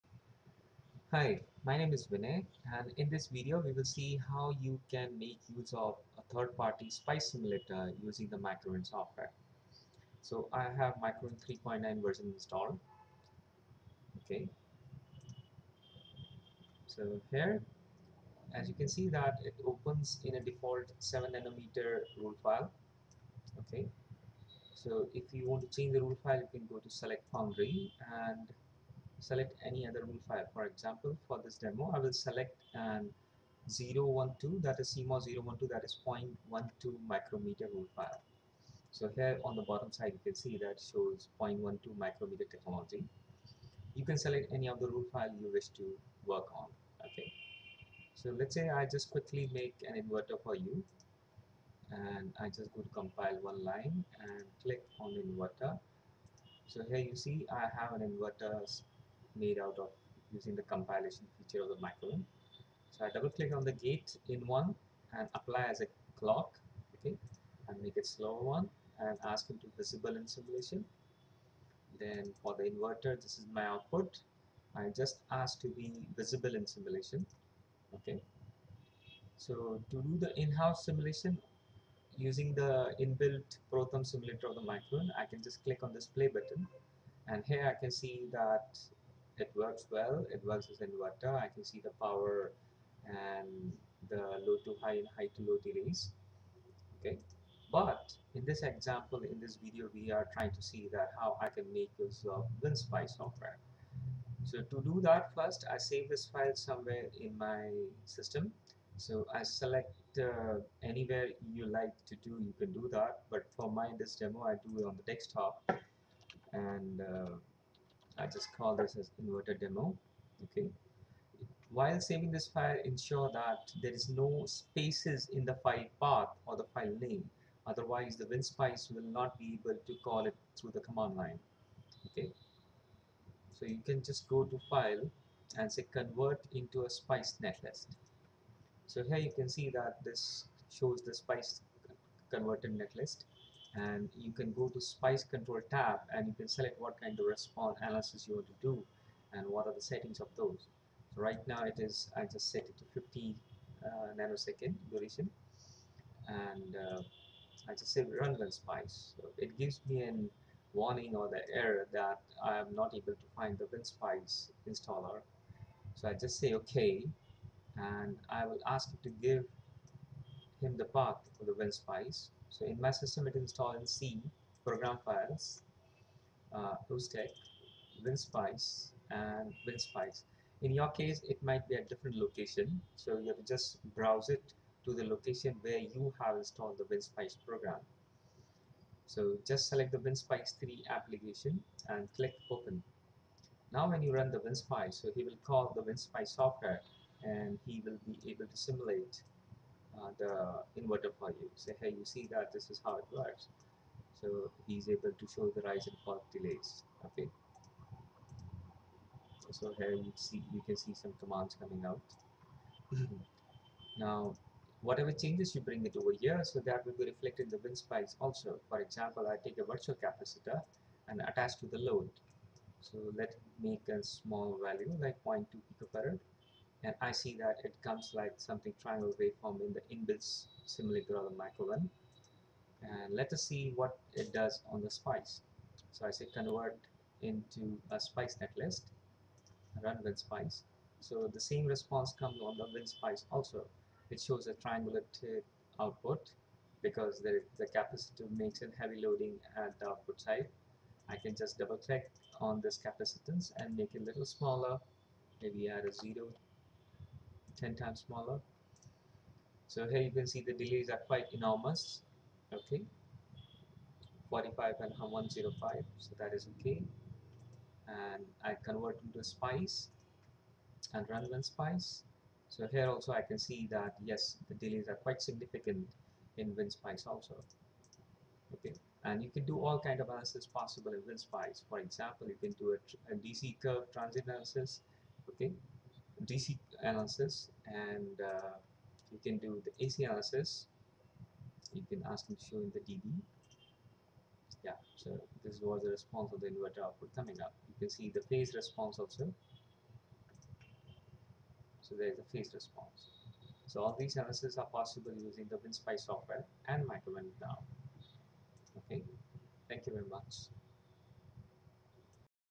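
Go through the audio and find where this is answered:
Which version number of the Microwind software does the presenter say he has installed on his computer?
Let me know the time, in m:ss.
0:11.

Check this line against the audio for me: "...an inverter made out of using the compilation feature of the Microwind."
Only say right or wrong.
right.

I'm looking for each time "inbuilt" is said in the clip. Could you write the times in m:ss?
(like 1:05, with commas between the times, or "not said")
1:23, 3:49.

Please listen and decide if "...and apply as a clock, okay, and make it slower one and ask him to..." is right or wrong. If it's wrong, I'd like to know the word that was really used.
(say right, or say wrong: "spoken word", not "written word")
right.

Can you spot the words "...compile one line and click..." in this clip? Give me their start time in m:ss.
0:52.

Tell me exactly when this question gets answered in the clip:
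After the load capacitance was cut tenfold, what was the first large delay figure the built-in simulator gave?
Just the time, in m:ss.
4:24.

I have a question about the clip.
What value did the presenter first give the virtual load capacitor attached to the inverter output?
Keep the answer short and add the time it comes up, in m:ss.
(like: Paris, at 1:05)
0.2 picofarad, at 3:45.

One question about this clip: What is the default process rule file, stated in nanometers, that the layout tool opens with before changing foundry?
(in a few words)
7 nanometer.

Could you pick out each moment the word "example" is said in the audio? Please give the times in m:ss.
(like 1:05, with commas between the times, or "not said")
0:30, 1:38, 3:38, 4:41.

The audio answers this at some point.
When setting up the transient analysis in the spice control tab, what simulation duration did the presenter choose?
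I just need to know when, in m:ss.
2:32.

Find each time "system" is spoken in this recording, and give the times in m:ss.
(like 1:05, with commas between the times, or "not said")
1:48, 2:52.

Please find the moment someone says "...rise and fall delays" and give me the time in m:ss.
3:25.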